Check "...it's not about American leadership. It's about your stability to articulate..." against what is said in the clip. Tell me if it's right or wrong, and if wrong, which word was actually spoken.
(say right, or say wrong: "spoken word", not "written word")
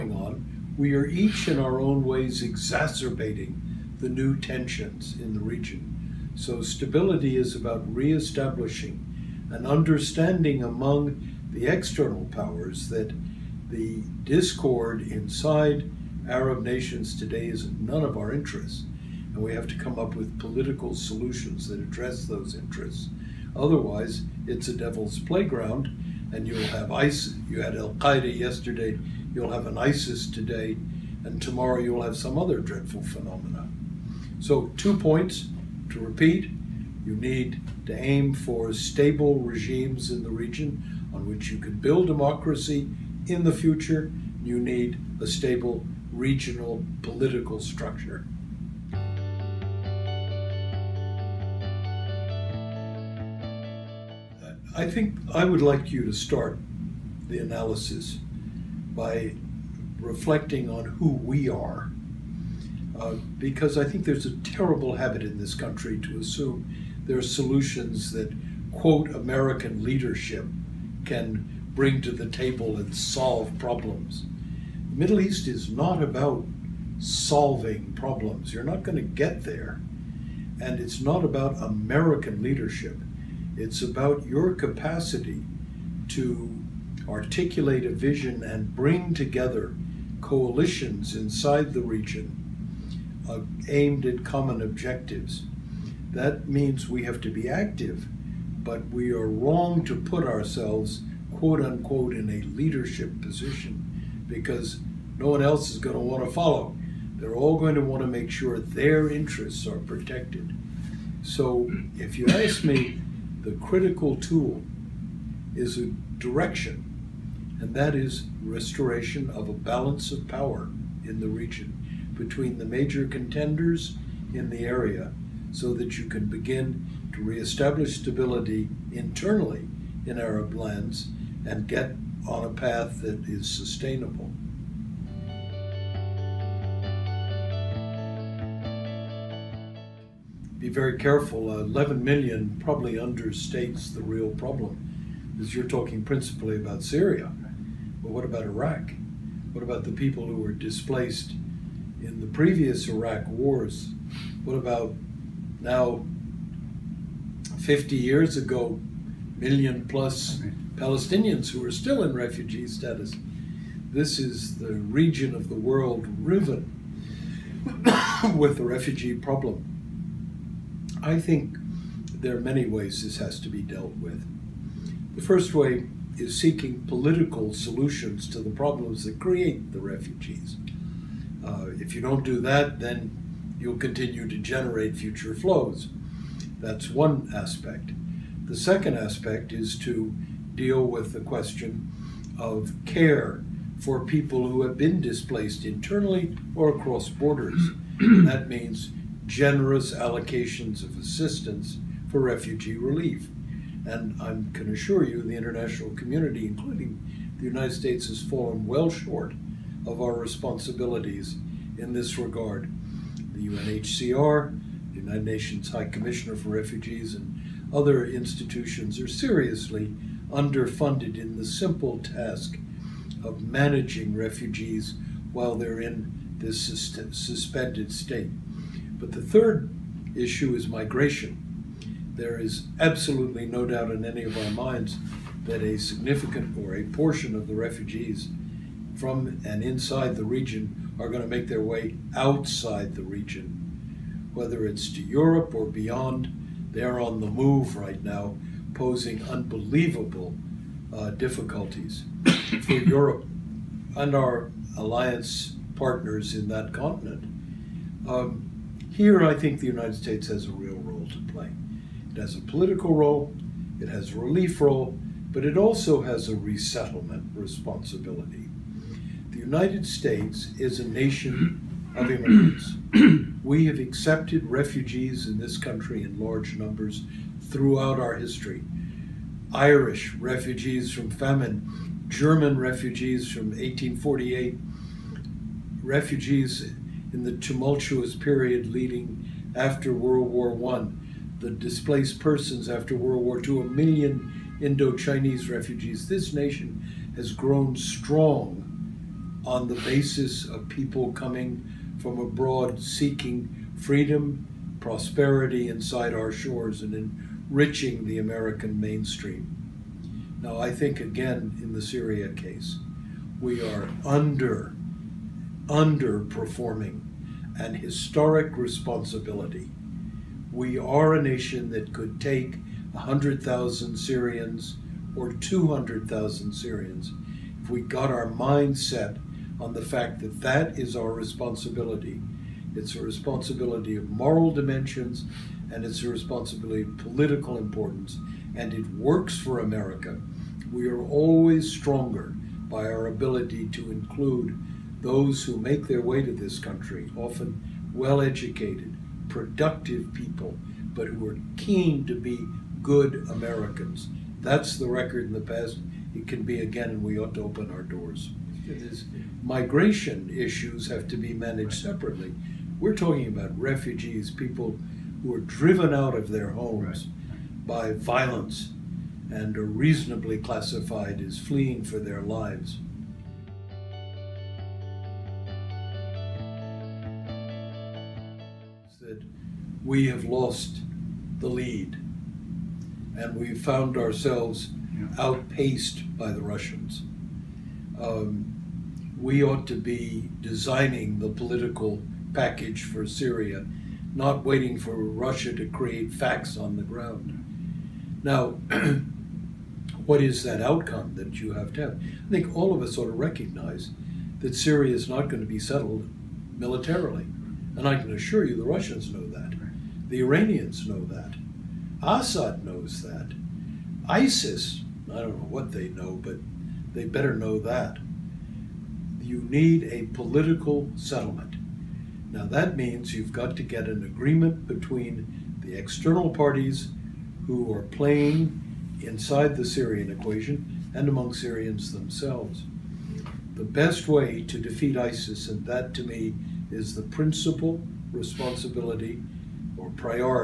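wrong: "capacity", not "stability".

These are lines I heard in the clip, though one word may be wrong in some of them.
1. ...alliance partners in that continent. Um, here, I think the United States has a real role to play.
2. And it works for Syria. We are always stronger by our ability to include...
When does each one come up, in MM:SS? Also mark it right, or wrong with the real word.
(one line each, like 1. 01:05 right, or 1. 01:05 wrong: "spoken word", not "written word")
1. 04:14 right
2. 05:38 wrong: "America", not "Syria".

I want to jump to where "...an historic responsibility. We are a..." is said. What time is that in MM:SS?
05:17.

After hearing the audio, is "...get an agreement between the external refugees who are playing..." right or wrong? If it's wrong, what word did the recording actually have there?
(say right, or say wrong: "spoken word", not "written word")
wrong: "parties", not "refugees".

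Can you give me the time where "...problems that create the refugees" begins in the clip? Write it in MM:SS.
02:58.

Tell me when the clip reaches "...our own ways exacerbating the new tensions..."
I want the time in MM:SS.
00:01.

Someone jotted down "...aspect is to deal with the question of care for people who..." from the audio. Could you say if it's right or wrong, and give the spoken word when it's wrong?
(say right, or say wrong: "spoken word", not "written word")
right.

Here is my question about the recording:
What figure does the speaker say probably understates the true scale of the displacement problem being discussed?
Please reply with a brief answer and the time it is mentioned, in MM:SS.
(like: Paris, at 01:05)
11 million, at 02:21.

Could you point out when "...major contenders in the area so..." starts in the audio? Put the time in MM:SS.
02:02.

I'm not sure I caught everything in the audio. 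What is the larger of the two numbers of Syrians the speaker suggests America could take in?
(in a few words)
200,000.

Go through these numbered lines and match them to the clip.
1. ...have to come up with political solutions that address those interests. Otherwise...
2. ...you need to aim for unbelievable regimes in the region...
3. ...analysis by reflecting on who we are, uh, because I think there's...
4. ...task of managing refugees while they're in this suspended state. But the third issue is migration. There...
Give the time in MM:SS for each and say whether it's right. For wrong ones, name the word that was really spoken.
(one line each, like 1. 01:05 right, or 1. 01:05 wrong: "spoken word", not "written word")
1. 00:19 right
2. 00:37 wrong: "stable", not "unbelievable"
3. 00:57 right
4. 03:41 right.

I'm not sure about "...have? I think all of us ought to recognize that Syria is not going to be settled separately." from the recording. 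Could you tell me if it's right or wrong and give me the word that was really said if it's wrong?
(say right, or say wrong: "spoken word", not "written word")
wrong: "militarily", not "separately".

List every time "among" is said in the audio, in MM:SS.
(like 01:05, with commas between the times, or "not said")
00:10, 07:11.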